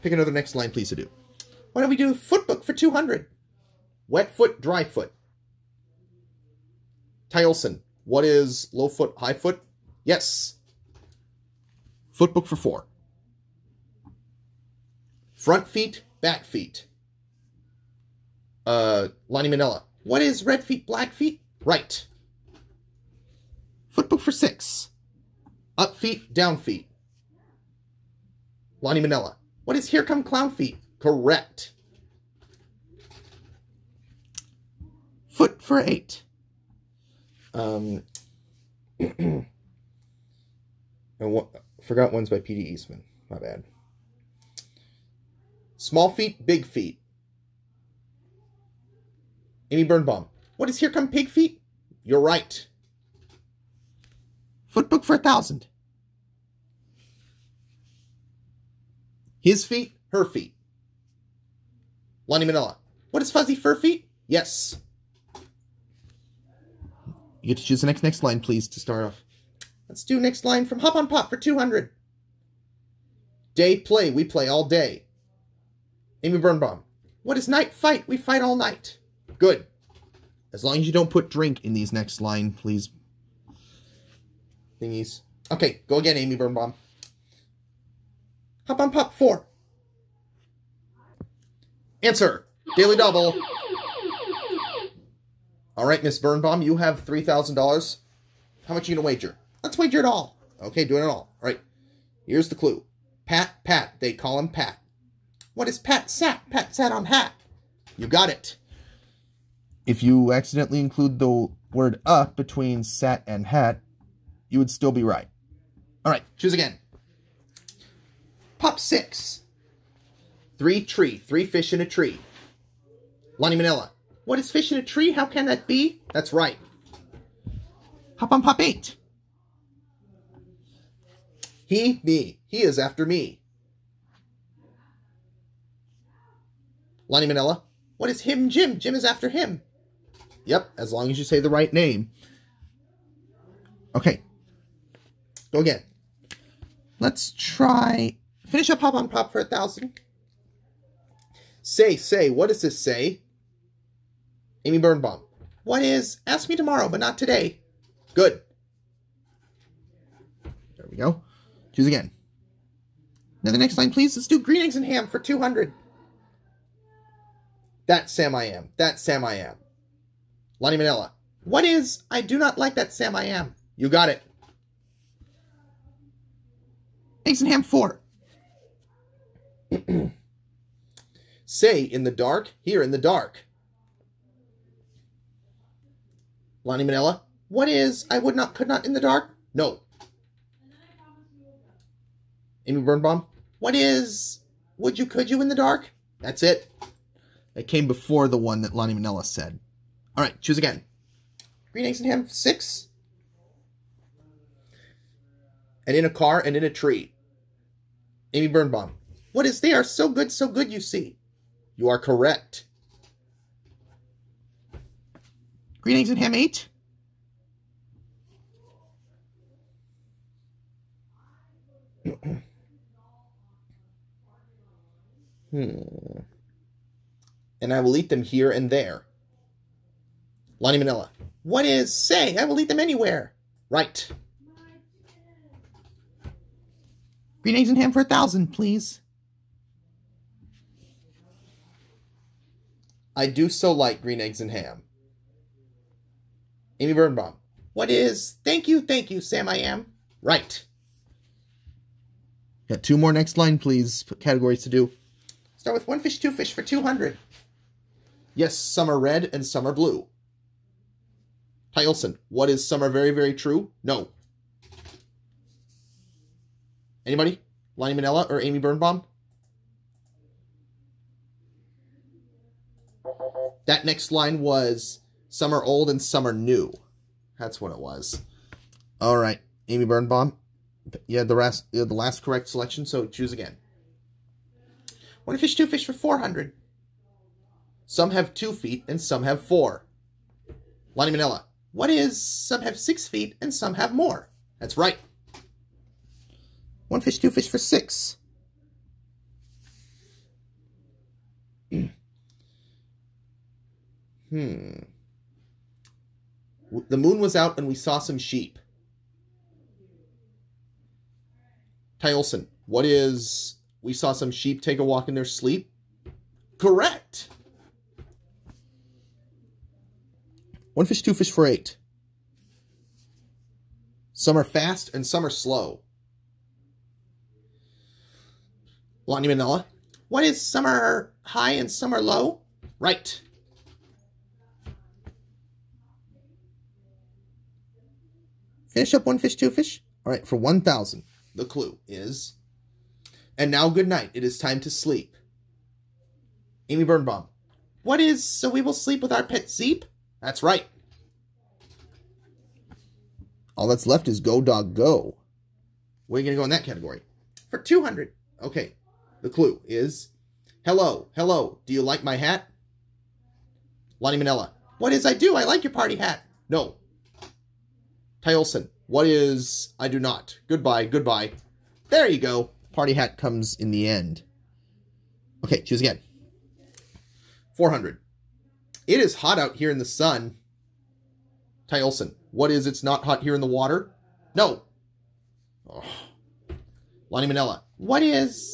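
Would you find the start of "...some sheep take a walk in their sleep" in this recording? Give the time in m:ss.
5:14.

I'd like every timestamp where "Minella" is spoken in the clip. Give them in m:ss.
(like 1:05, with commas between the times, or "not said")
1:02, 2:03, 2:17, 3:50, 4:28, 5:29, 6:04.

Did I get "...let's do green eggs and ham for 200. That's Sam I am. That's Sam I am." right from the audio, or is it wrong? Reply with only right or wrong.
right.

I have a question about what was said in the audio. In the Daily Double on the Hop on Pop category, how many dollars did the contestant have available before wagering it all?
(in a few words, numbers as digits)
$3,000.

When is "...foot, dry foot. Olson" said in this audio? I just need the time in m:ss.
0:04.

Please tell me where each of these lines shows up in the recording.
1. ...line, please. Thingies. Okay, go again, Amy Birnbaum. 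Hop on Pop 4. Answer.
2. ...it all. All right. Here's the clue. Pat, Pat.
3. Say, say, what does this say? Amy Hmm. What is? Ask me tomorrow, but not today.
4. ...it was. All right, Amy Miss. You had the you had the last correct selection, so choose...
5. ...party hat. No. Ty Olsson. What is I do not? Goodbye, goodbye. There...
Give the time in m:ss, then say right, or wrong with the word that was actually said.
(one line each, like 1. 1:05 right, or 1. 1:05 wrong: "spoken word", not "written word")
1. 1:22 right
2. 1:41 right
3. 2:31 wrong: "Birnbaum", not "Hmm"
4. 4:37 wrong: "Birnbaum", not "Miss"
5. 6:05 right.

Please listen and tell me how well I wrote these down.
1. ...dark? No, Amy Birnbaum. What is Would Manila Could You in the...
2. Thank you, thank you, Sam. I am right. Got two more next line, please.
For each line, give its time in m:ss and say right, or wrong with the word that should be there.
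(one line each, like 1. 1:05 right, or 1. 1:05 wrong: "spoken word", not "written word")
1. 3:09 wrong: "You", not "Manila"
2. 4:08 right.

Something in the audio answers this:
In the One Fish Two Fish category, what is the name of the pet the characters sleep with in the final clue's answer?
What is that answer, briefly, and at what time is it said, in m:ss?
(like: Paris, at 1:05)
Zeep, at 5:49.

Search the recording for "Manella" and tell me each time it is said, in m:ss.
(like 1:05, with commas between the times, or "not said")
0:19, 0:29, 3:18, 6:27.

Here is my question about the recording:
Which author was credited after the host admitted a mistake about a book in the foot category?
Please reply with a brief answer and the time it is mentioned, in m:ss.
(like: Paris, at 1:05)
P.D. Eastman, at 0:42.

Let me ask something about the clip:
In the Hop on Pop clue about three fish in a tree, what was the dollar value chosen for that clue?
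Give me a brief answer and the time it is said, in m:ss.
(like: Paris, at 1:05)
600, at 1:58.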